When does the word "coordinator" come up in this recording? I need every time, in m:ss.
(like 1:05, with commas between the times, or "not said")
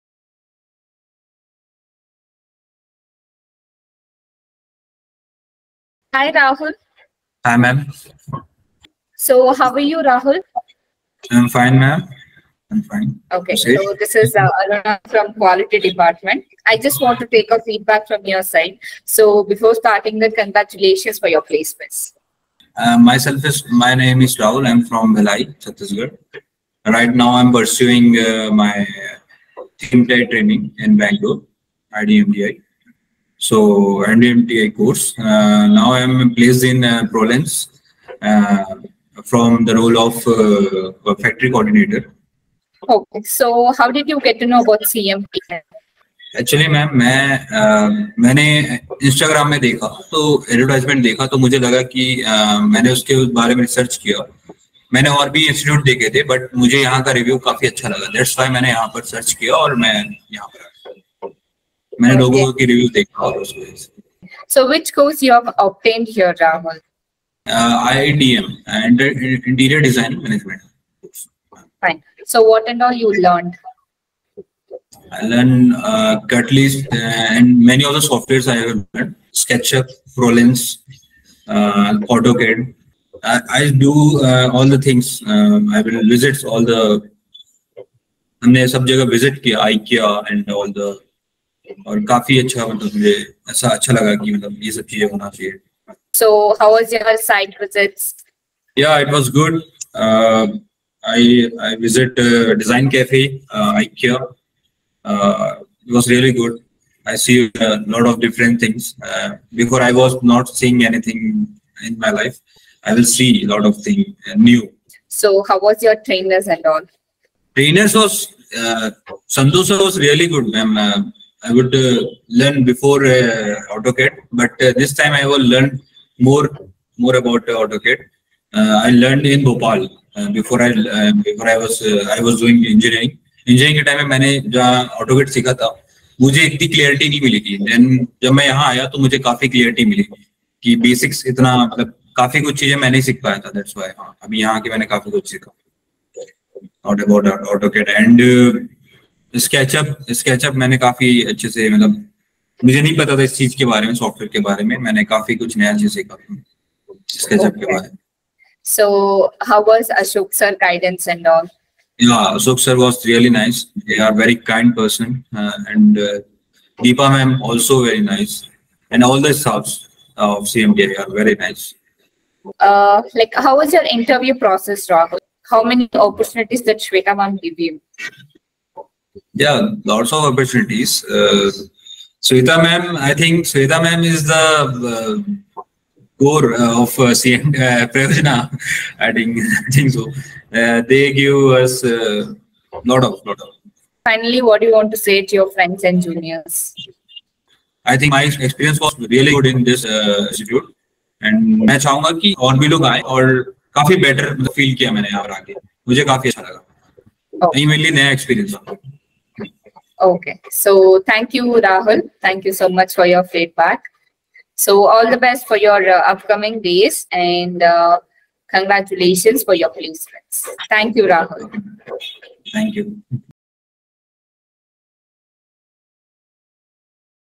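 0:41.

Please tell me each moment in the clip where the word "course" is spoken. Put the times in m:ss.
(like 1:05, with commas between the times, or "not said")
0:34, 1:04.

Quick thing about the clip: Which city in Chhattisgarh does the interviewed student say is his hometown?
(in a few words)
Bhilai.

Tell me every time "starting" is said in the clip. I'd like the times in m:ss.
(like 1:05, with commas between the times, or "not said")
0:19.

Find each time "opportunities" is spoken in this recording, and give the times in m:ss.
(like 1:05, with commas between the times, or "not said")
2:56, 3:00.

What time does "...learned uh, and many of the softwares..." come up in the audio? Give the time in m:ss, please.
1:15.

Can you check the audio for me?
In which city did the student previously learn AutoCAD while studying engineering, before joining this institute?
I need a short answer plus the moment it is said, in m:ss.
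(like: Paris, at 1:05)
Bhopal, at 2:09.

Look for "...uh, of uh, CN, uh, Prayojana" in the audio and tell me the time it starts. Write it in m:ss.
3:06.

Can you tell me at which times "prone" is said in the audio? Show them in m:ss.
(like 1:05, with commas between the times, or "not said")
not said.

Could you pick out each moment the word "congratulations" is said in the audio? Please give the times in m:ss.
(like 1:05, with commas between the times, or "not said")
0:20, 3:38.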